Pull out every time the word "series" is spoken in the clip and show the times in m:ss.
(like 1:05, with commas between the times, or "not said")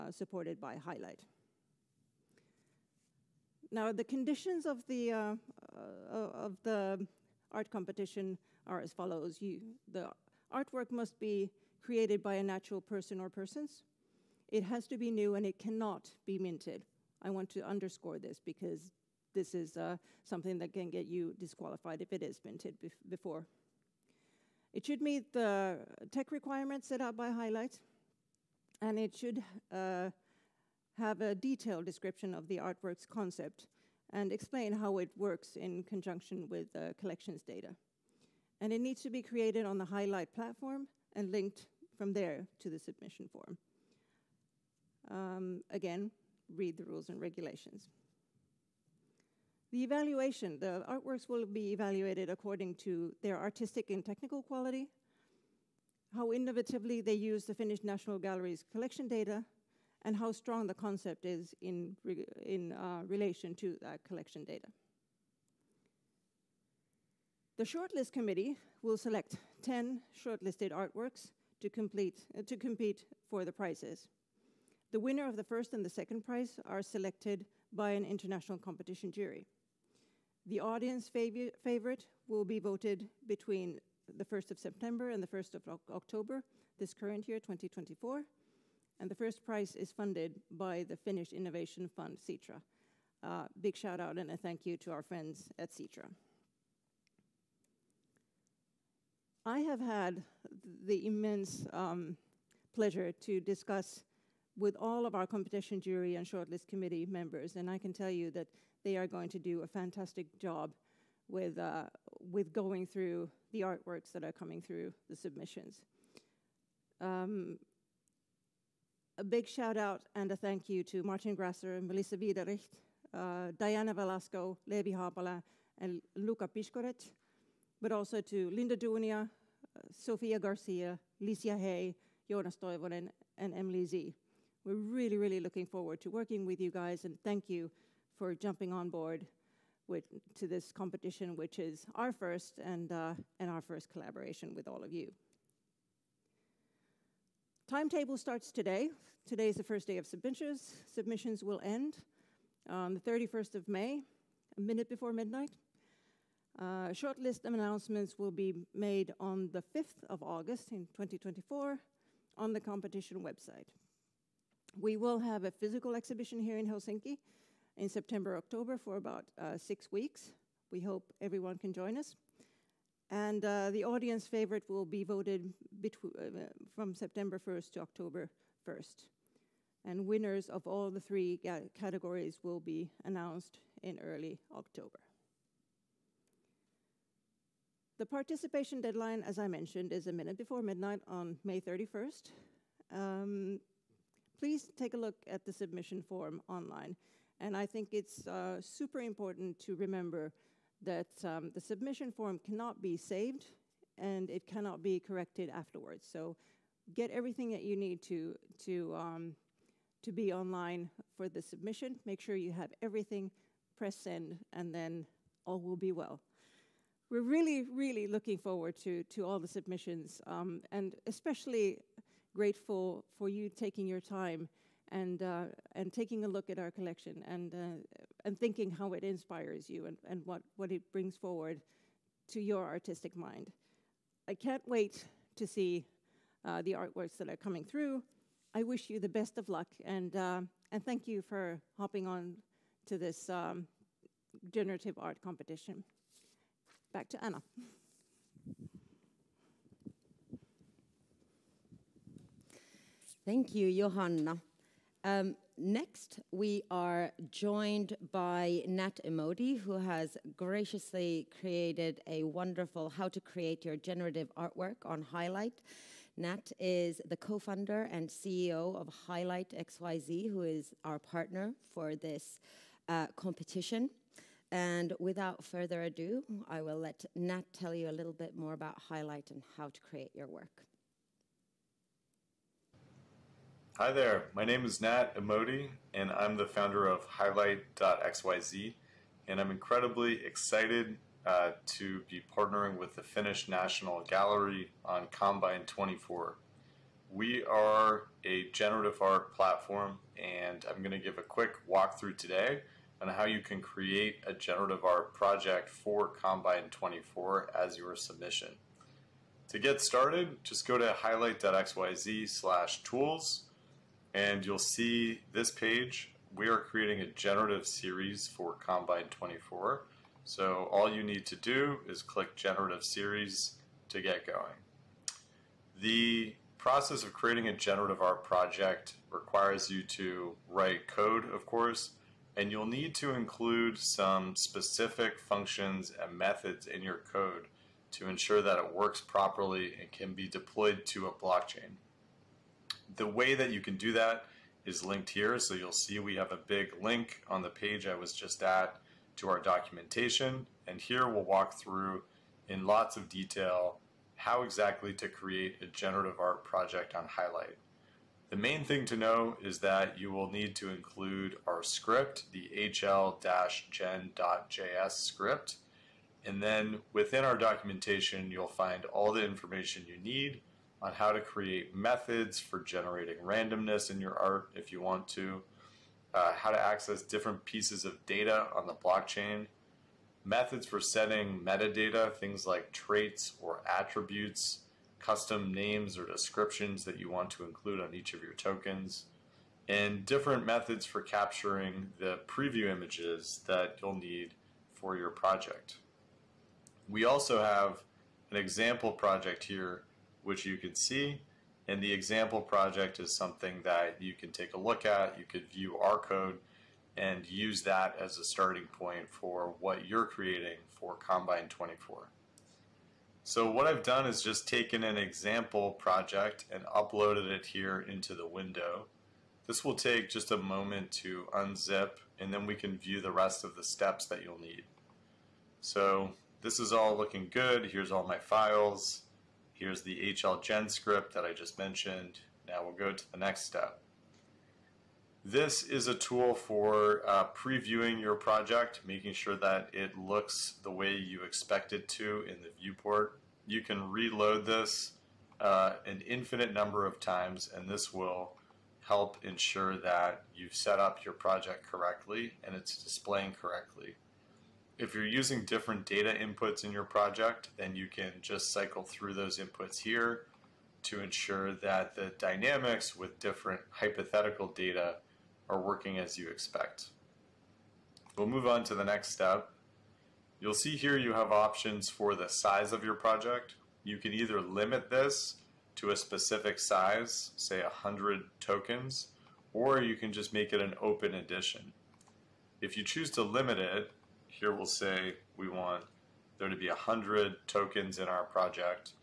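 5:17, 5:22.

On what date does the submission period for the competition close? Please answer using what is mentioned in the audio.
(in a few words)
May 31.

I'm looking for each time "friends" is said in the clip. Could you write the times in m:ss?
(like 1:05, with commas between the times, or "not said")
1:35.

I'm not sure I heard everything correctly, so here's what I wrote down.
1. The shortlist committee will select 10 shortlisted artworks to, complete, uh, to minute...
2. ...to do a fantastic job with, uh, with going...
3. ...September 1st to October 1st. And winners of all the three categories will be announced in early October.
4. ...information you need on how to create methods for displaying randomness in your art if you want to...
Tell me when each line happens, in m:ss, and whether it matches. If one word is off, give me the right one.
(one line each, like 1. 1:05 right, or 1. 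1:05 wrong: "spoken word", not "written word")
1. 1:07 wrong: "compete", not "minute"
2. 1:49 right
3. 2:56 right
4. 6:09 wrong: "generating", not "displaying".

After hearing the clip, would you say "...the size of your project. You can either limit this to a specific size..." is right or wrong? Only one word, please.
right.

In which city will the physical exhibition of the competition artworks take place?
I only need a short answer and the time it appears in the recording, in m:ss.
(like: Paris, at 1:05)
Helsinki, at 2:46.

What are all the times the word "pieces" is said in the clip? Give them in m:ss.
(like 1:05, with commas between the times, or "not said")
6:17.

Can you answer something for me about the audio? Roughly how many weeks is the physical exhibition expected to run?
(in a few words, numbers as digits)
6.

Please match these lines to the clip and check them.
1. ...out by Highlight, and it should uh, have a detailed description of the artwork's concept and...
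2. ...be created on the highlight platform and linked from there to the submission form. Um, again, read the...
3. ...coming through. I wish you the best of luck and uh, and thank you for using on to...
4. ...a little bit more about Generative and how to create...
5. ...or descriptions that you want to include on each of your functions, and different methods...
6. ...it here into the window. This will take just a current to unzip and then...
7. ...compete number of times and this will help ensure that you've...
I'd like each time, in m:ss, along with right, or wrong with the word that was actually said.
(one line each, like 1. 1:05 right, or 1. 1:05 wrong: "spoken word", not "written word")
1. 0:27 right
2. 0:39 right
3. 3:57 wrong: "hopping", not "using"
4. 4:37 wrong: "Highlight", not "Generative"
5. 6:25 wrong: "tokens", not "functions"
6. 6:57 wrong: "moment", not "current"
7. 7:26 wrong: "infinite", not "compete".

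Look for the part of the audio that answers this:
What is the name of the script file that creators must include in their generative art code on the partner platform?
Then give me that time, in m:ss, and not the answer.
6:02.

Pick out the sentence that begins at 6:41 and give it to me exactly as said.
And the example project is something that you can take a look at.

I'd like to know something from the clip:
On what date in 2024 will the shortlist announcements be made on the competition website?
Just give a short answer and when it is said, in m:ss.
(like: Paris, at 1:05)
August 5, at 2:39.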